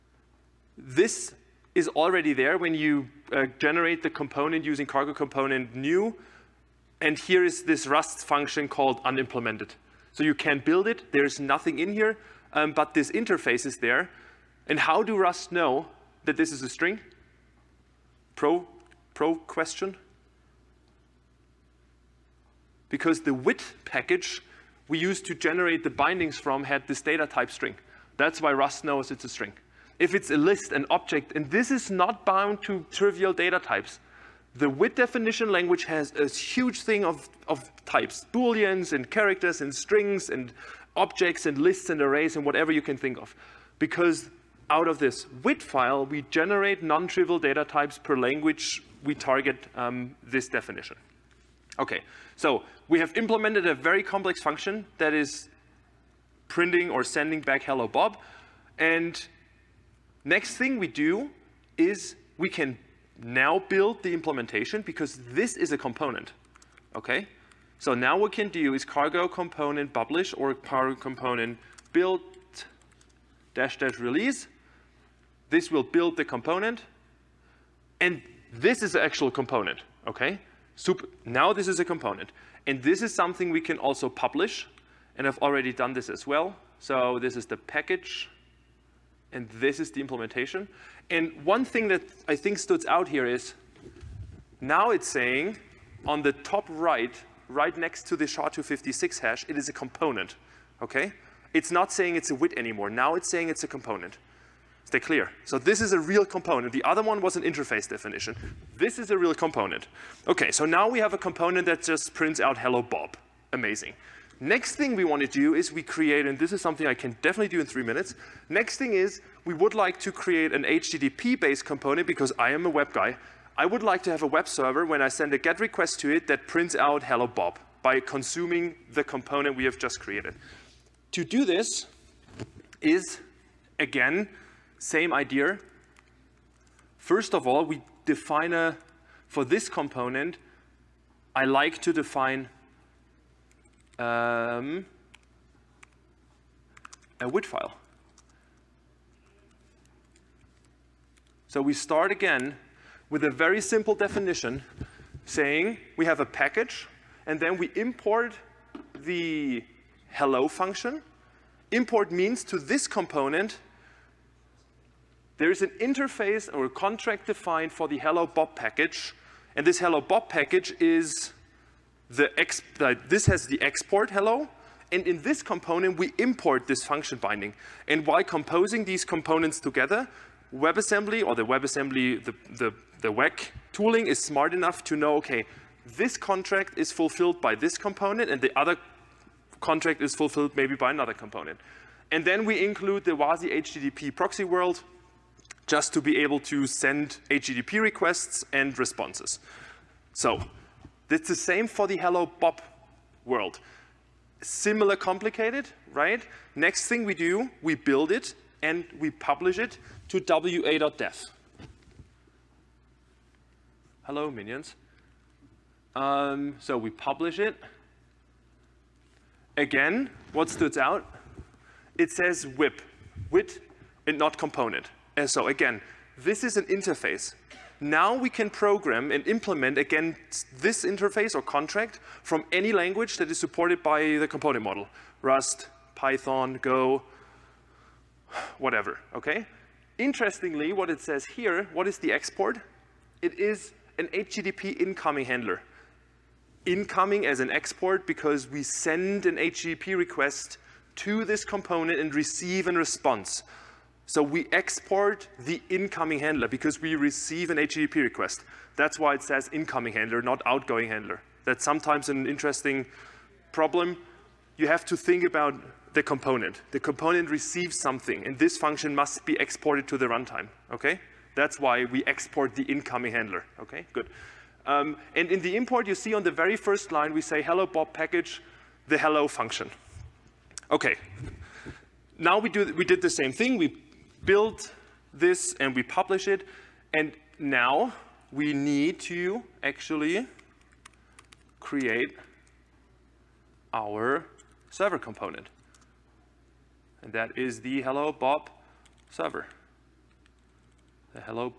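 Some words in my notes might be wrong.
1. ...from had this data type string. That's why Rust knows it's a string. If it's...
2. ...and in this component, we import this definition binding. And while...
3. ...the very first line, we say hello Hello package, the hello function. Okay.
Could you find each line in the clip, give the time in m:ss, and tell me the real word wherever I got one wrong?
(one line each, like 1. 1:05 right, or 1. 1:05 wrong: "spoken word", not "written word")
1. 0:26 right
2. 2:54 wrong: "function", not "definition"
3. 4:36 wrong: "Bob", not "Hello".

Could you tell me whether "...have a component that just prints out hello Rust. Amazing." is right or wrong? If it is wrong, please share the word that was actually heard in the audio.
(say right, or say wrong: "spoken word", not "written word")
wrong: "Bob", not "Rust".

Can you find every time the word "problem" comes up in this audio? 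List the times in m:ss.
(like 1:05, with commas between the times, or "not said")
4:23.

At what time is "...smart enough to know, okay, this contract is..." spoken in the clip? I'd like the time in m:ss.
3:04.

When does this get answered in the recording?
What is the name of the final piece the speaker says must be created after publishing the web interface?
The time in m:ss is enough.
4:57.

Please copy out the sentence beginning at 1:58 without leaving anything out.
Next thing is we would like to create an HTTP-based component because I am a web guy.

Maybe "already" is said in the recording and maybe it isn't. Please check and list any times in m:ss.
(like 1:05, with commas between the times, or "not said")
0:01, 1:25.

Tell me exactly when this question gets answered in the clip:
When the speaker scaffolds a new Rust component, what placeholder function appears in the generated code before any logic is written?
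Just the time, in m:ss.
0:09.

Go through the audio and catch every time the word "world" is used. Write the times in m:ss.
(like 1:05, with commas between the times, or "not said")
3:14, 3:23.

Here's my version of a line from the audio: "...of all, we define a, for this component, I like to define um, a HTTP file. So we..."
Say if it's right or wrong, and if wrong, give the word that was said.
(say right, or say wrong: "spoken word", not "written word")
wrong: "WIT", not "HTTP".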